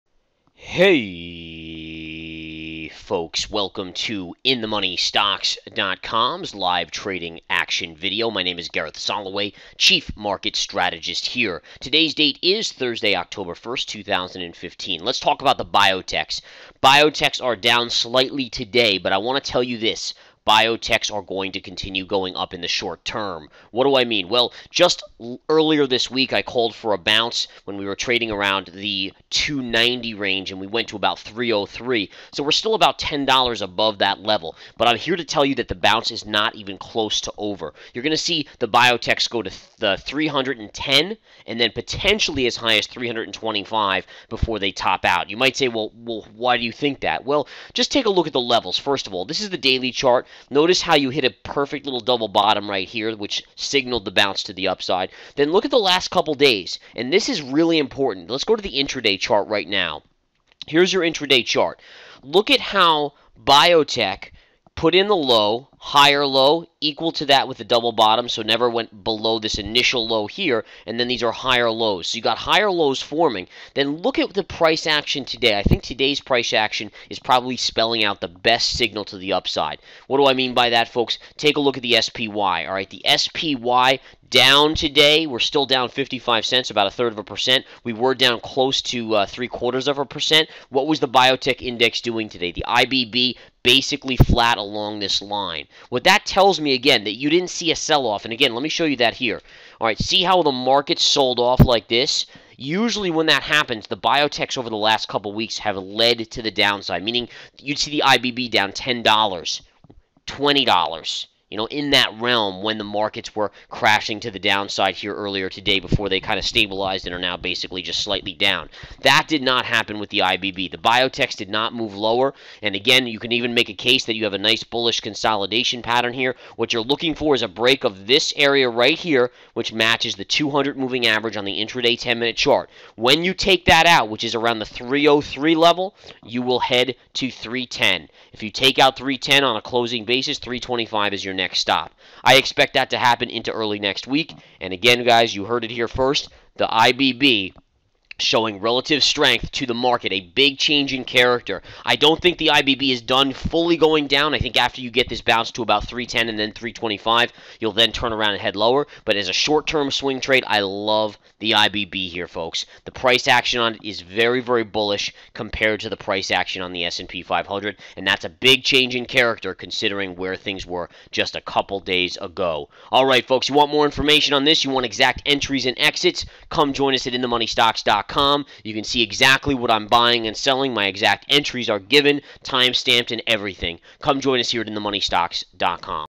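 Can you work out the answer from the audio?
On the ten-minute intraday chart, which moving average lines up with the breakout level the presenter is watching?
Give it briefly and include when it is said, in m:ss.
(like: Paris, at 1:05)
200 moving average, at 2:10.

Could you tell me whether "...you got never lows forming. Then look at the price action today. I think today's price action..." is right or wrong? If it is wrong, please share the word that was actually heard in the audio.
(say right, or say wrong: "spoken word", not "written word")
wrong: "higher", not "never".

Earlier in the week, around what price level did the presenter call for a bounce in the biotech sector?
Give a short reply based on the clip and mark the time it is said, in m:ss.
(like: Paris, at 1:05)
290, at 0:29.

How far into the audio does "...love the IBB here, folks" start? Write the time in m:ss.
2:40.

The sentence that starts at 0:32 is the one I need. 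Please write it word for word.
So we're still about $10 above that level.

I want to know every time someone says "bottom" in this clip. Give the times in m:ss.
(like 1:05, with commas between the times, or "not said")
0:52, 1:07.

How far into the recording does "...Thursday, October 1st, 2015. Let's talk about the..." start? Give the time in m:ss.
0:12.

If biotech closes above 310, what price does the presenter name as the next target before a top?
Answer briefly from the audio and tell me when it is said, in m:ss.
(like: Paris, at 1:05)
325, at 2:20.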